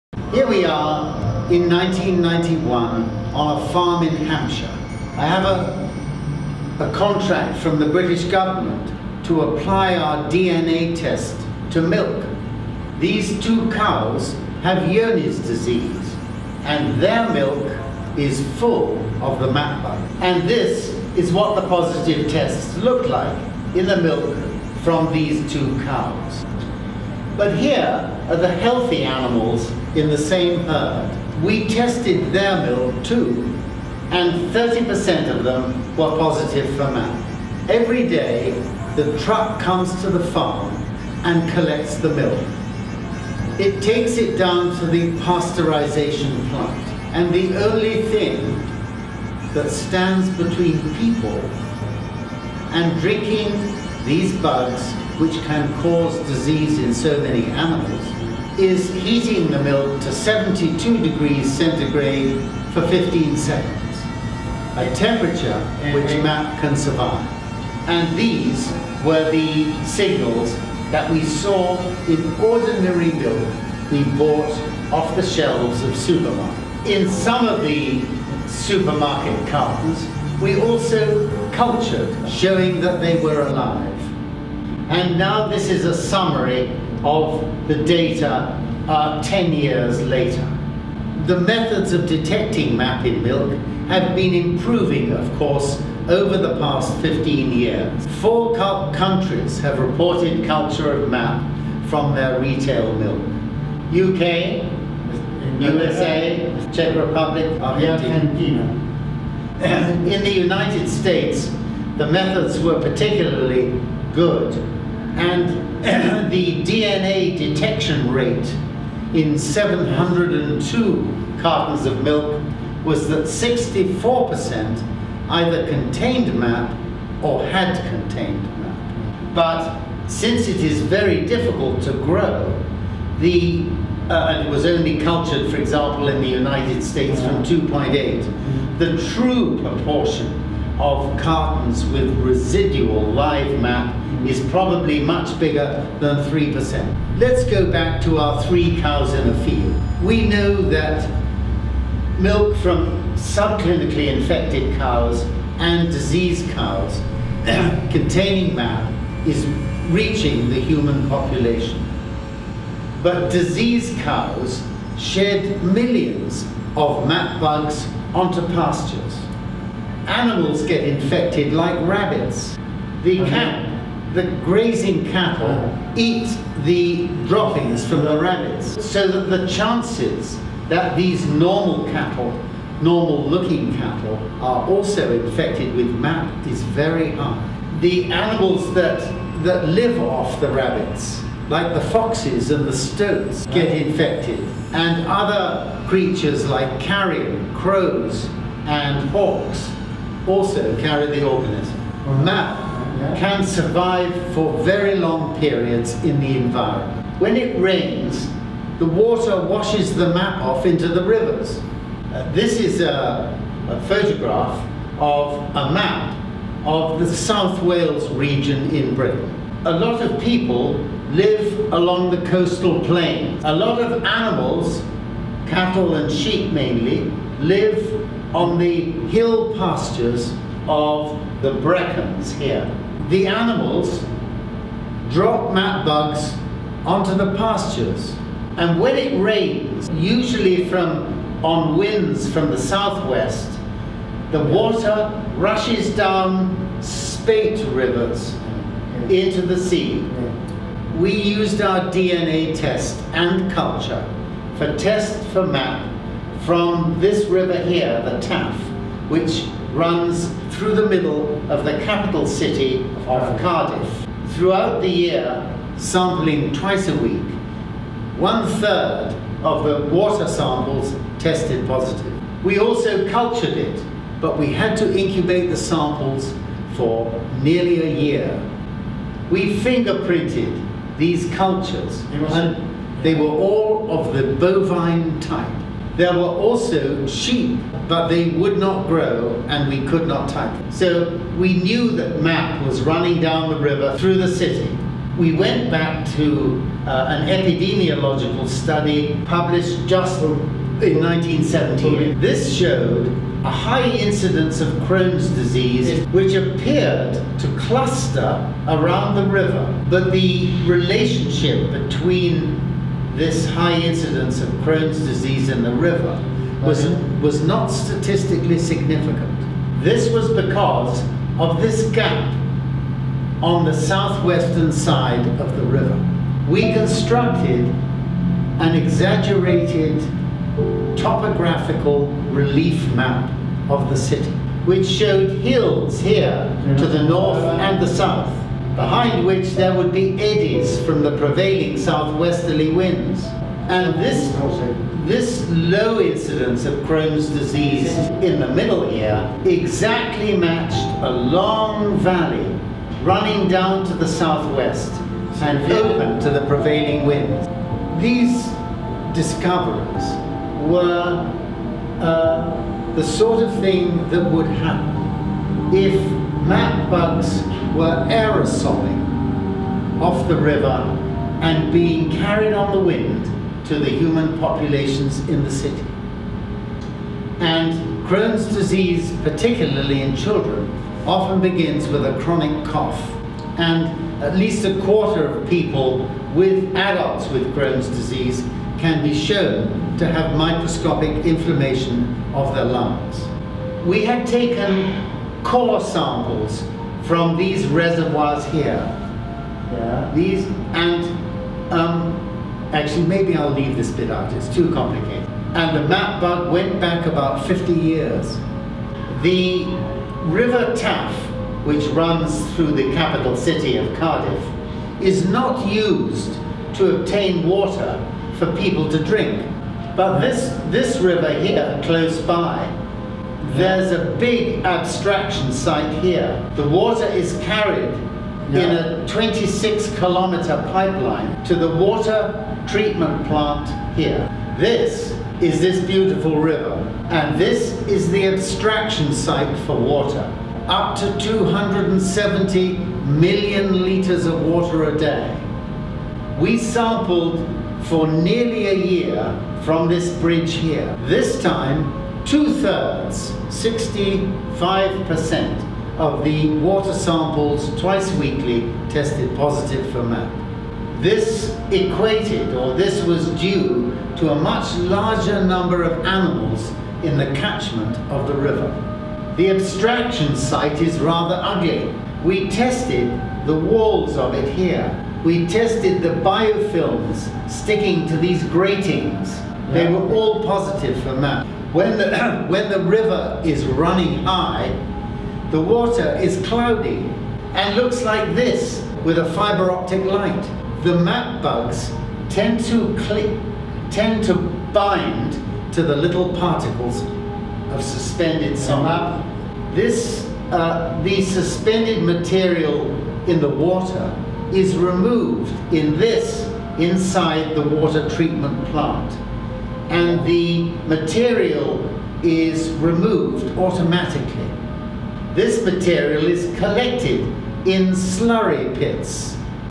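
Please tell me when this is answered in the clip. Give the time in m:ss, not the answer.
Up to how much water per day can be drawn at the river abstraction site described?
7:21.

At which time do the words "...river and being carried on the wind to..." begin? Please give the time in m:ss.
6:10.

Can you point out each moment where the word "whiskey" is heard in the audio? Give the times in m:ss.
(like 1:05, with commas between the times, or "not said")
not said.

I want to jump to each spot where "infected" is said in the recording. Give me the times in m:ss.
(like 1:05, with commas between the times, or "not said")
2:34, 2:50, 3:05, 3:13.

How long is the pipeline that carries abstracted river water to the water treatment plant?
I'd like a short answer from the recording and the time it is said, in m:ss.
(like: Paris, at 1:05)
26 kilometers, at 7:09.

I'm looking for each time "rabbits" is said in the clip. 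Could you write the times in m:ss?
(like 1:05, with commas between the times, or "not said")
2:51, 2:58, 3:10.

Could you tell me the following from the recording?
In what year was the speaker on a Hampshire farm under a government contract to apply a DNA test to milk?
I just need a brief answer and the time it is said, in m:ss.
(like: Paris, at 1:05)
1991, at 0:01.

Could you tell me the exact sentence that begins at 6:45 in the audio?
And the map bug went back about 50 years.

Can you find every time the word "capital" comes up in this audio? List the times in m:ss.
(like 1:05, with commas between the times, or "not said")
4:21, 6:52.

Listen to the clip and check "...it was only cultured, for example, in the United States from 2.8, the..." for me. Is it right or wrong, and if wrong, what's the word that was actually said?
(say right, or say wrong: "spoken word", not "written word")
right.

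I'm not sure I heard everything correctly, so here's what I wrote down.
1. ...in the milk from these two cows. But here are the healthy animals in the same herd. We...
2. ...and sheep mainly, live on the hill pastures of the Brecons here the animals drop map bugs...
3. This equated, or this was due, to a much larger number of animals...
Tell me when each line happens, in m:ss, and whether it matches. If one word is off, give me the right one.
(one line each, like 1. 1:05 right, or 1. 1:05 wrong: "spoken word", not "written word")
1. 0:23 right
2. 3:45 right
3. 7:41 right.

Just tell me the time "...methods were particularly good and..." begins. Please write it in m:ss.
1:52.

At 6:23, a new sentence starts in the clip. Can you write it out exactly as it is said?
And at least a quarter of people with adults with Crohn's disease can be shown to have microscopic inflammation of their lungs.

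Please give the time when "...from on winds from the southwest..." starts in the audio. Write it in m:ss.
4:00.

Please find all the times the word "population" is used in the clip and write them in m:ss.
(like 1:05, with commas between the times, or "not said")
2:41, 6:14.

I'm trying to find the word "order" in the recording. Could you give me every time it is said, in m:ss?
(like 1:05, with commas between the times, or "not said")
not said.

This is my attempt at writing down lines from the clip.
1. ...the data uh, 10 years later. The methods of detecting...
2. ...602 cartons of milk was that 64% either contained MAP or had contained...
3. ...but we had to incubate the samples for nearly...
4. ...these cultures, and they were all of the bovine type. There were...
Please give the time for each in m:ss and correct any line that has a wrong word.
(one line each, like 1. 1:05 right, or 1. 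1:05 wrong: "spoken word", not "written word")
1. 1:27 right
2. 1:59 wrong: "702", not "602"
3. 4:34 right
4. 4:40 right.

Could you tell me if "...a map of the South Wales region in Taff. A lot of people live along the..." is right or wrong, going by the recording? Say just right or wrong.
wrong.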